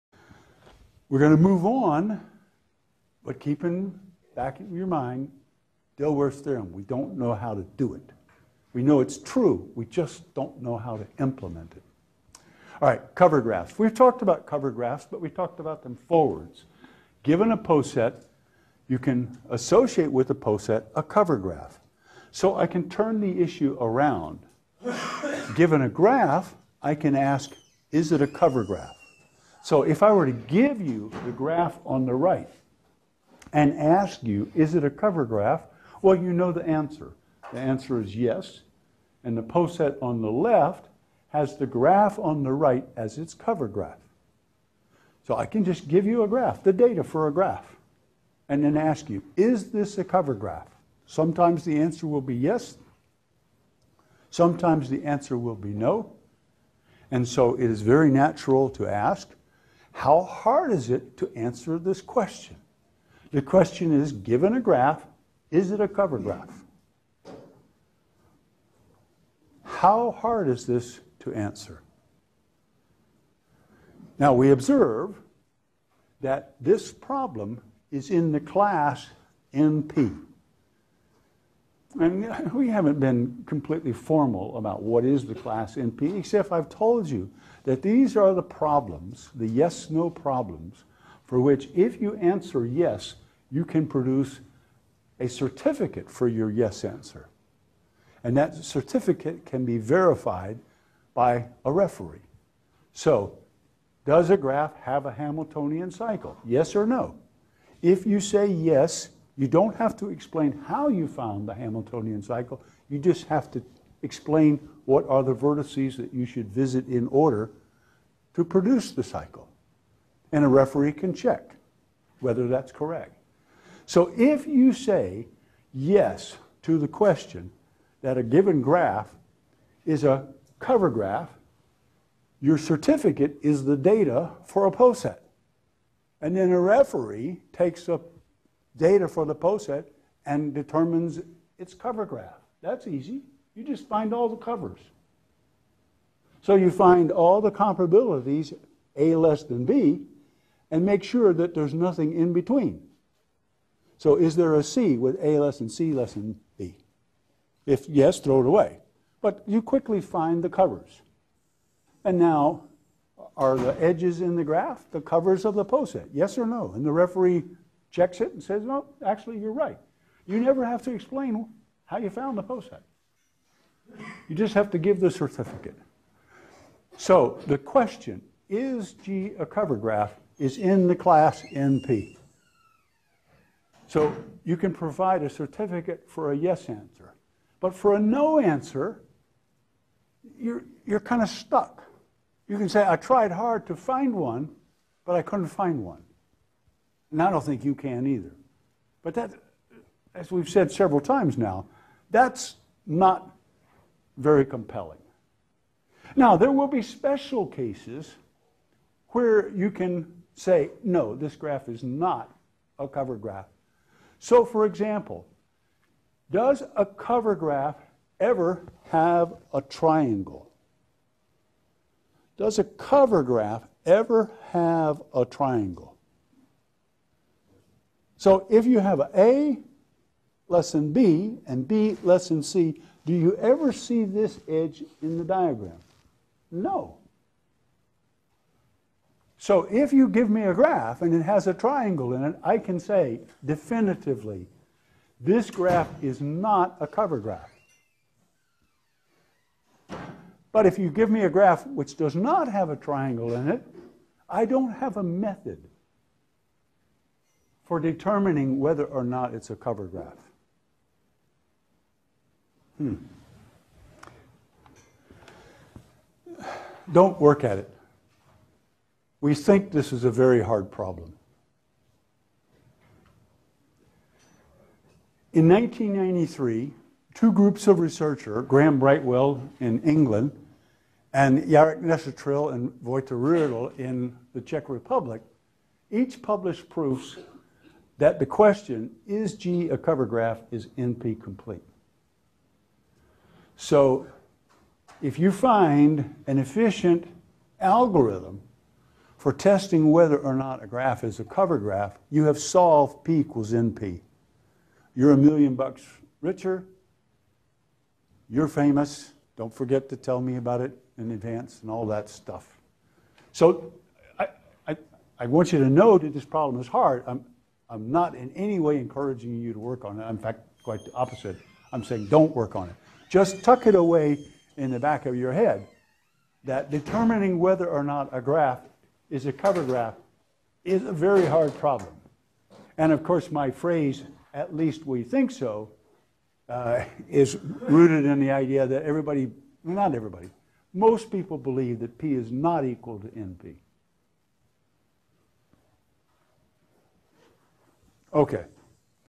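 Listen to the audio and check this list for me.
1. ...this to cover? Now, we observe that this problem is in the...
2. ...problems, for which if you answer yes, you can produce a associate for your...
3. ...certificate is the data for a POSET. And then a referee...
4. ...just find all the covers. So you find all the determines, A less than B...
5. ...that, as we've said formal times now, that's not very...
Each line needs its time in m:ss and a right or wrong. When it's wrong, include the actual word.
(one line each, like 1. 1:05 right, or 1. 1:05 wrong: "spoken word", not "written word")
1. 1:10 wrong: "answer", not "cover"
2. 1:30 wrong: "certificate", not "associate"
3. 2:12 right
4. 2:23 wrong: "comparabilities", not "determines"
5. 3:19 wrong: "several", not "formal".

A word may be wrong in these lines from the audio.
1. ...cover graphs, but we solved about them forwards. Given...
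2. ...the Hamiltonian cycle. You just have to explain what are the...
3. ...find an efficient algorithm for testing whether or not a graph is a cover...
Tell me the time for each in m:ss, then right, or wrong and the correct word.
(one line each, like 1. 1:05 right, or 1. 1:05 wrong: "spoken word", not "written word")
1. 0:14 wrong: "talked", not "solved"
2. 1:51 right
3. 4:55 right.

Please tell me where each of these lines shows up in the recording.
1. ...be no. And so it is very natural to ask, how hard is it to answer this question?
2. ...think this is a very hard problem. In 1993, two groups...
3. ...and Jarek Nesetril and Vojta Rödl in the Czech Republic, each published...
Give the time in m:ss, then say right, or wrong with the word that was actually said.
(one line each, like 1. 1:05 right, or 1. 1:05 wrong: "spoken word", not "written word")
1. 0:55 right
2. 4:29 right
3. 4:41 right.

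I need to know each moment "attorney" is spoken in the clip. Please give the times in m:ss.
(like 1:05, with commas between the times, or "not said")
not said.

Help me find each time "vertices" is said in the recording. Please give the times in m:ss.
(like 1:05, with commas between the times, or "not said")
1:55.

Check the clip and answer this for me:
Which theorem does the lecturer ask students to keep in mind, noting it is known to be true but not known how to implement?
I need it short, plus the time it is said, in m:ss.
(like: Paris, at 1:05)
Dilworth's theorem, at 0:05.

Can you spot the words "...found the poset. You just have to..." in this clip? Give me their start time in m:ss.
2:52.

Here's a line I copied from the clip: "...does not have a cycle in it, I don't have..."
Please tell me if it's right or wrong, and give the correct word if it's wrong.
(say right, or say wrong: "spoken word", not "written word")
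wrong: "triangle", not "cycle".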